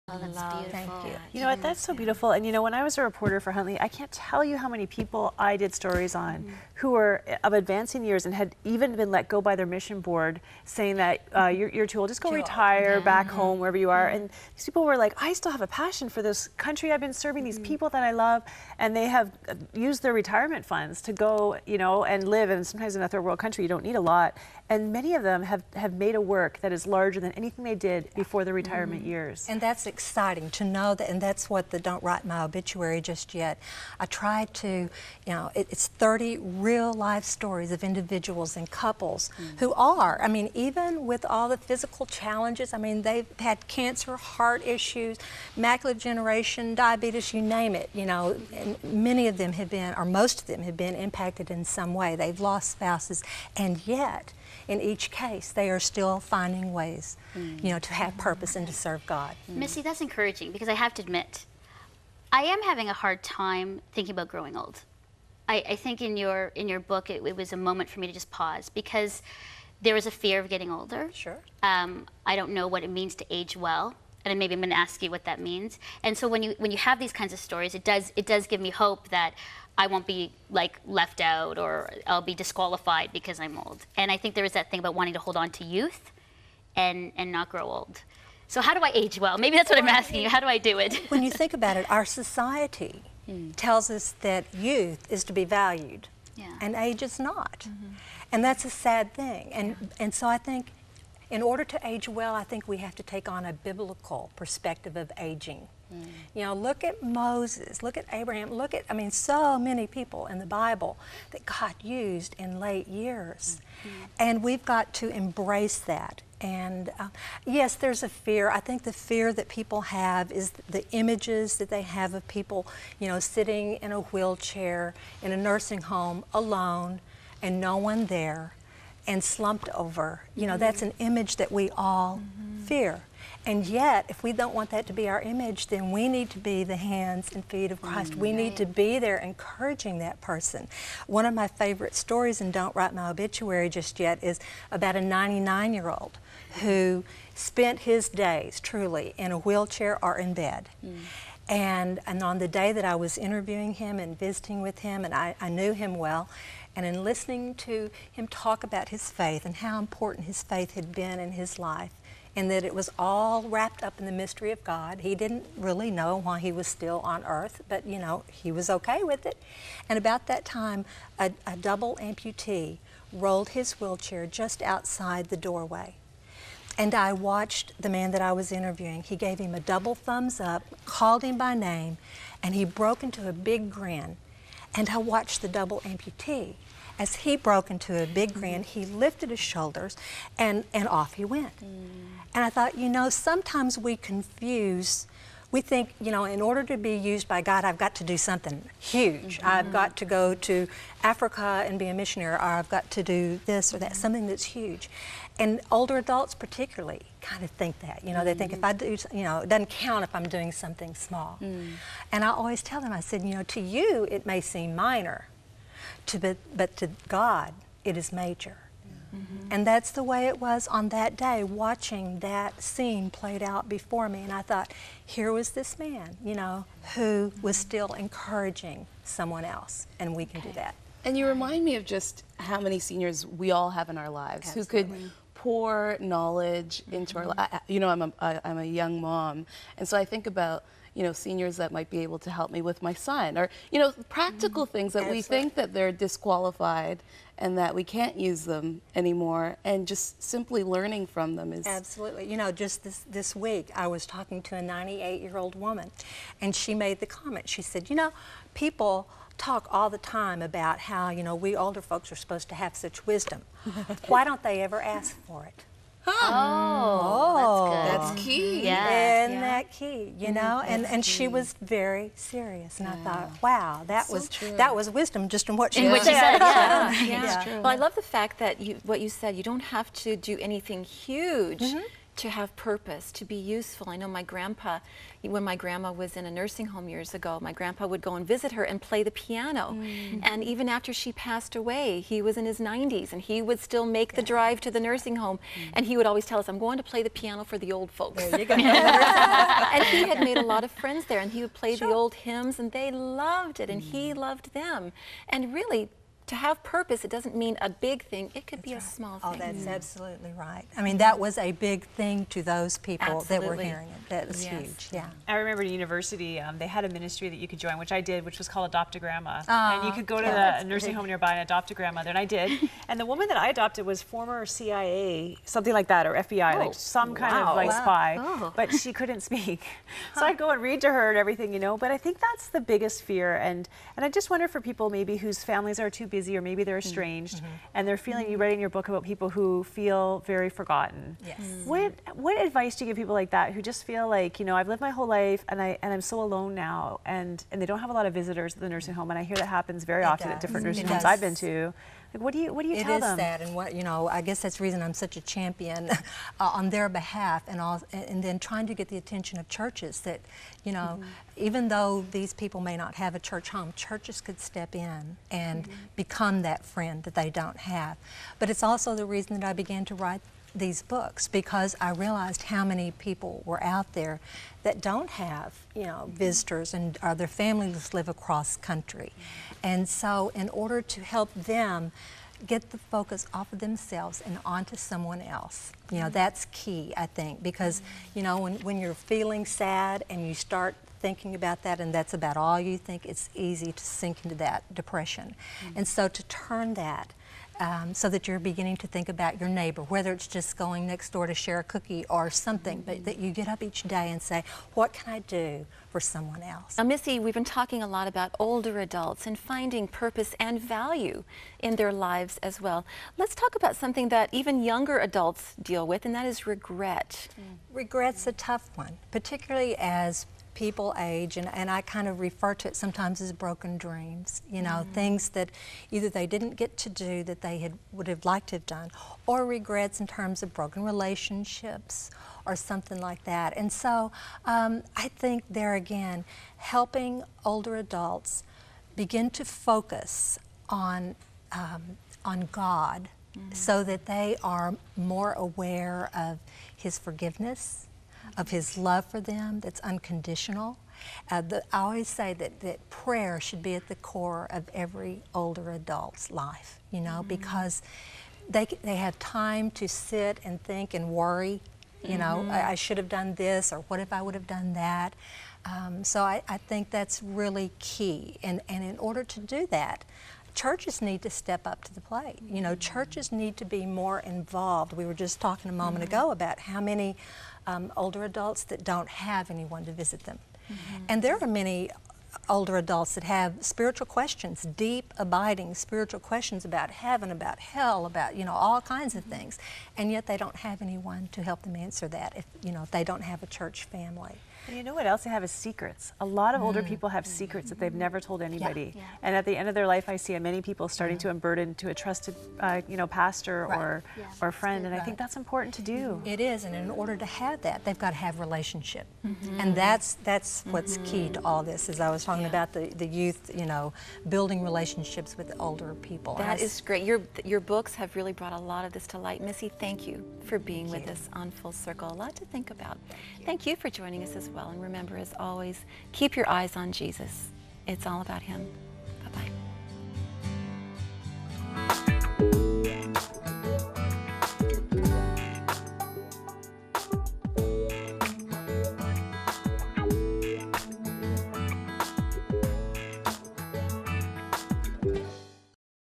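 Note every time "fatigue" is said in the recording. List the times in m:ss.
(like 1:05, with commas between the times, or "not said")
not said.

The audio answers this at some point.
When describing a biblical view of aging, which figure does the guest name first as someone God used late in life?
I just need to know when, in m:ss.
1:47.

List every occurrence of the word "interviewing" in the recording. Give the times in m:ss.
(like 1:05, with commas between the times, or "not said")
2:33, 2:58.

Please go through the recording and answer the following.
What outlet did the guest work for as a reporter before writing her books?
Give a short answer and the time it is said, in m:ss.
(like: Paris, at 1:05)
Huntley, at 0:03.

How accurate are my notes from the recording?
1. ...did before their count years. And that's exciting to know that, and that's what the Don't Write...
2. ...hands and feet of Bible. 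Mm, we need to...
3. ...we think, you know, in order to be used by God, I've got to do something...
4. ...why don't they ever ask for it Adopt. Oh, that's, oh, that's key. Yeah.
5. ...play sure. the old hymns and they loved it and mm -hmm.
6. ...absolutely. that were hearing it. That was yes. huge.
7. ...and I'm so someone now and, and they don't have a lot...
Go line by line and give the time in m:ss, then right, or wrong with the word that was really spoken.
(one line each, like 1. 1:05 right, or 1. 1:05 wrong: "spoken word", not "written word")
1. 0:27 wrong: "retirement", not "count"
2. 2:16 wrong: "Christ", not "Bible"
3. 3:15 right
4. 4:24 wrong: "Huh", not "Adopt"
5. 5:01 right
6. 5:13 right
7. 5:45 wrong: "alone", not "someone".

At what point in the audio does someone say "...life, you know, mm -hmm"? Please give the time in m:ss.
7:36.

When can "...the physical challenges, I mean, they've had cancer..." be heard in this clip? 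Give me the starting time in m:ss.
0:41.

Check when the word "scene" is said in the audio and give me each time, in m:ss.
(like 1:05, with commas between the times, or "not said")
3:42.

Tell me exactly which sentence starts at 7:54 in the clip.
We were just talking a moment mm -hmm.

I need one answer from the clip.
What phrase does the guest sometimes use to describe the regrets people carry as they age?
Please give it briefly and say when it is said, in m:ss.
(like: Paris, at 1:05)
broken dreams, at 7:03.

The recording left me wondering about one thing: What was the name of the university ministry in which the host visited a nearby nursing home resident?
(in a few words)
Adopt a Grandma.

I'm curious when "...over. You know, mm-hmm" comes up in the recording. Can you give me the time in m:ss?
2:09.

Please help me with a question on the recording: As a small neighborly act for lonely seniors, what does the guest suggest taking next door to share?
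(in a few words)
a cookie.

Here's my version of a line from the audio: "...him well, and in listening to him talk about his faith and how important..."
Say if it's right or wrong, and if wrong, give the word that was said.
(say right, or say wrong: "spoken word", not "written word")
right.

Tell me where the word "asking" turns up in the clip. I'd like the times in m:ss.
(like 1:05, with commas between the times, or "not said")
1:29.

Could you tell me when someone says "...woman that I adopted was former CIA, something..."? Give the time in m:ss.
5:23.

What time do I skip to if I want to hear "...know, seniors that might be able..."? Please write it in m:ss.
4:01.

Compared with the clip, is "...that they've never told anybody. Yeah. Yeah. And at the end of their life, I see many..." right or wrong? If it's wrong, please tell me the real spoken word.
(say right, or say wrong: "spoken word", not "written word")
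right.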